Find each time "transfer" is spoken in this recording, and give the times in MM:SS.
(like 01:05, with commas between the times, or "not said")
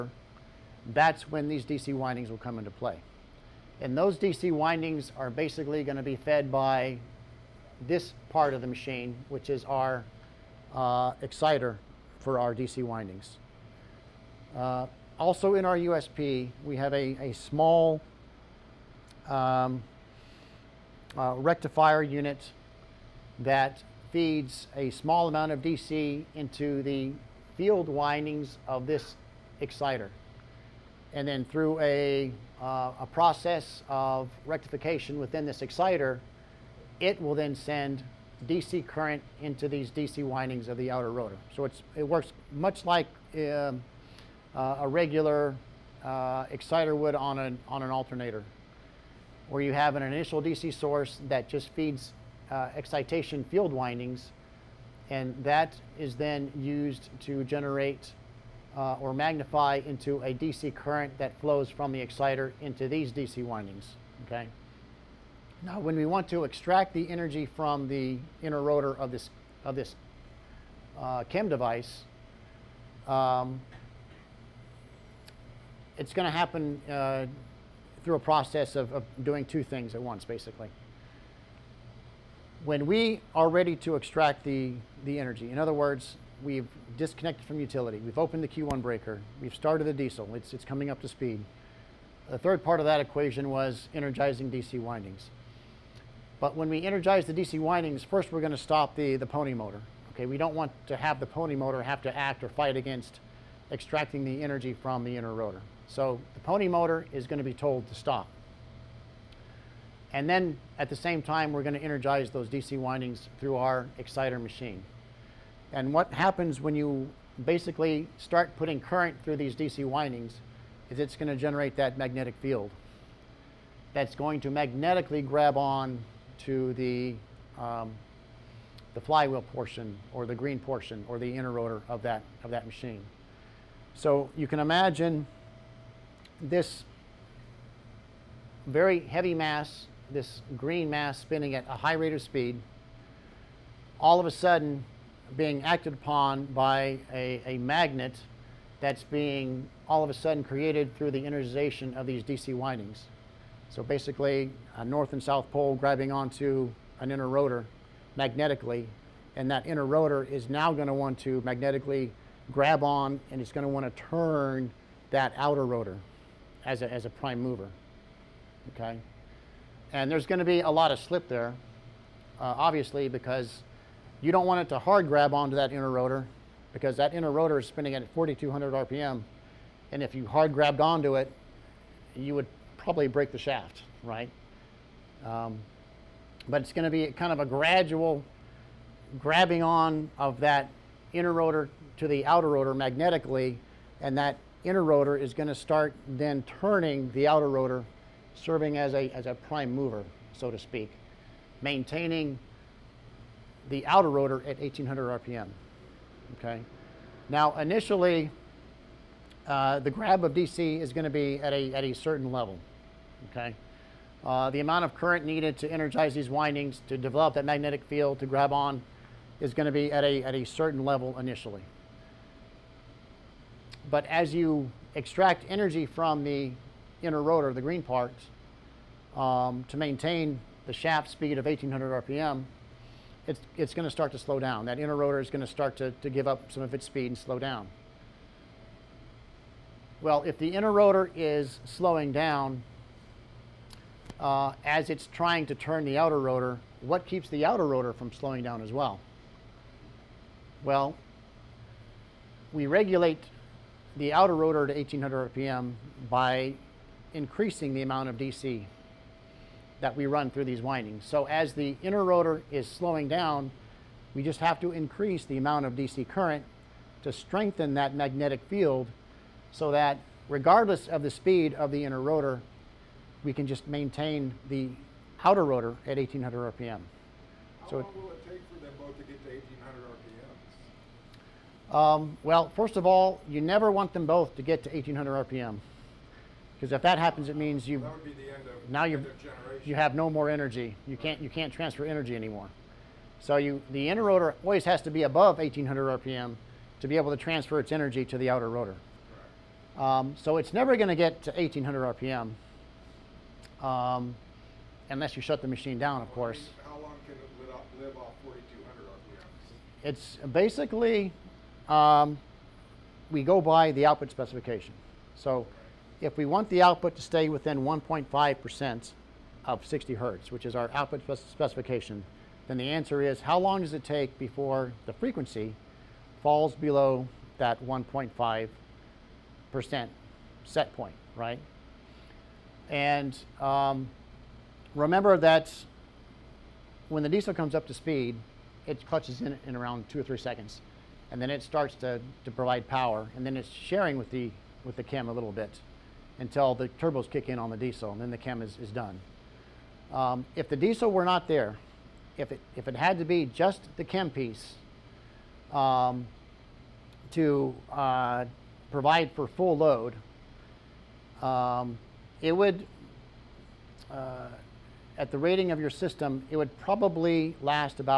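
04:51, 04:57.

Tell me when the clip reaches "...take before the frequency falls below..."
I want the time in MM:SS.
05:23.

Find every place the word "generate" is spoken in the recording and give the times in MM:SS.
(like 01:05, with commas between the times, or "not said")
00:57, 02:01.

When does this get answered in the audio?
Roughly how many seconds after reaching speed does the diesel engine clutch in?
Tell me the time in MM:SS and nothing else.
05:39.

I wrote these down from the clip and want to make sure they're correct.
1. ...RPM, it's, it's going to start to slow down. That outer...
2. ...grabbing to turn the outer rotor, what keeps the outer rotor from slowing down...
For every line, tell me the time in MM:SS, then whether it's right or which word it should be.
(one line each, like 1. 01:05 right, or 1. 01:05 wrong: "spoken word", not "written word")
1. 03:52 wrong: "inner", not "outer"
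2. 04:05 wrong: "trying", not "grabbing".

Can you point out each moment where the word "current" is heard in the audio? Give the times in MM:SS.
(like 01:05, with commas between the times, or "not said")
00:38, 01:00, 01:58, 03:34, 04:26.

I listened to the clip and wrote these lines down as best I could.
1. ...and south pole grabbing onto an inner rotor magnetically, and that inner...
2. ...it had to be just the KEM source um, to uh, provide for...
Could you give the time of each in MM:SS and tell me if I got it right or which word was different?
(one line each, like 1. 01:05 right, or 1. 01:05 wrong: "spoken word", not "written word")
1. 02:35 right
2. 05:52 wrong: "piece", not "source".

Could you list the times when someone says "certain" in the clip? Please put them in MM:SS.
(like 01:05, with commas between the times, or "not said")
03:31, 03:40.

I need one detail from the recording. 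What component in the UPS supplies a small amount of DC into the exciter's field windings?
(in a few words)
Rectifier unit.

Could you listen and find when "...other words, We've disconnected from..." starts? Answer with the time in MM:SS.
01:25.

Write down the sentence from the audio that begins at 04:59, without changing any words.
Um, so it's never going to get to 1800 RPM um, unless you shut the machine down, of course.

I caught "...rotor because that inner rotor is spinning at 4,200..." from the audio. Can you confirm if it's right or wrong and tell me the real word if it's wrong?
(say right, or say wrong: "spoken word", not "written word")
right.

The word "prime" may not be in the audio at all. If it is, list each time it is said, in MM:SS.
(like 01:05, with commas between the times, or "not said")
02:47, 03:19.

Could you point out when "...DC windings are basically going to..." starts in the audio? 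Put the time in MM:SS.
00:04.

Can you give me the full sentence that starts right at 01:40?
Okay, we don't want to have the pony motor have to act or fight against extracting the energy from the inner rotor.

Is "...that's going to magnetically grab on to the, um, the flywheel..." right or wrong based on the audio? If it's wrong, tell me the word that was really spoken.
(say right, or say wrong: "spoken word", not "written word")
right.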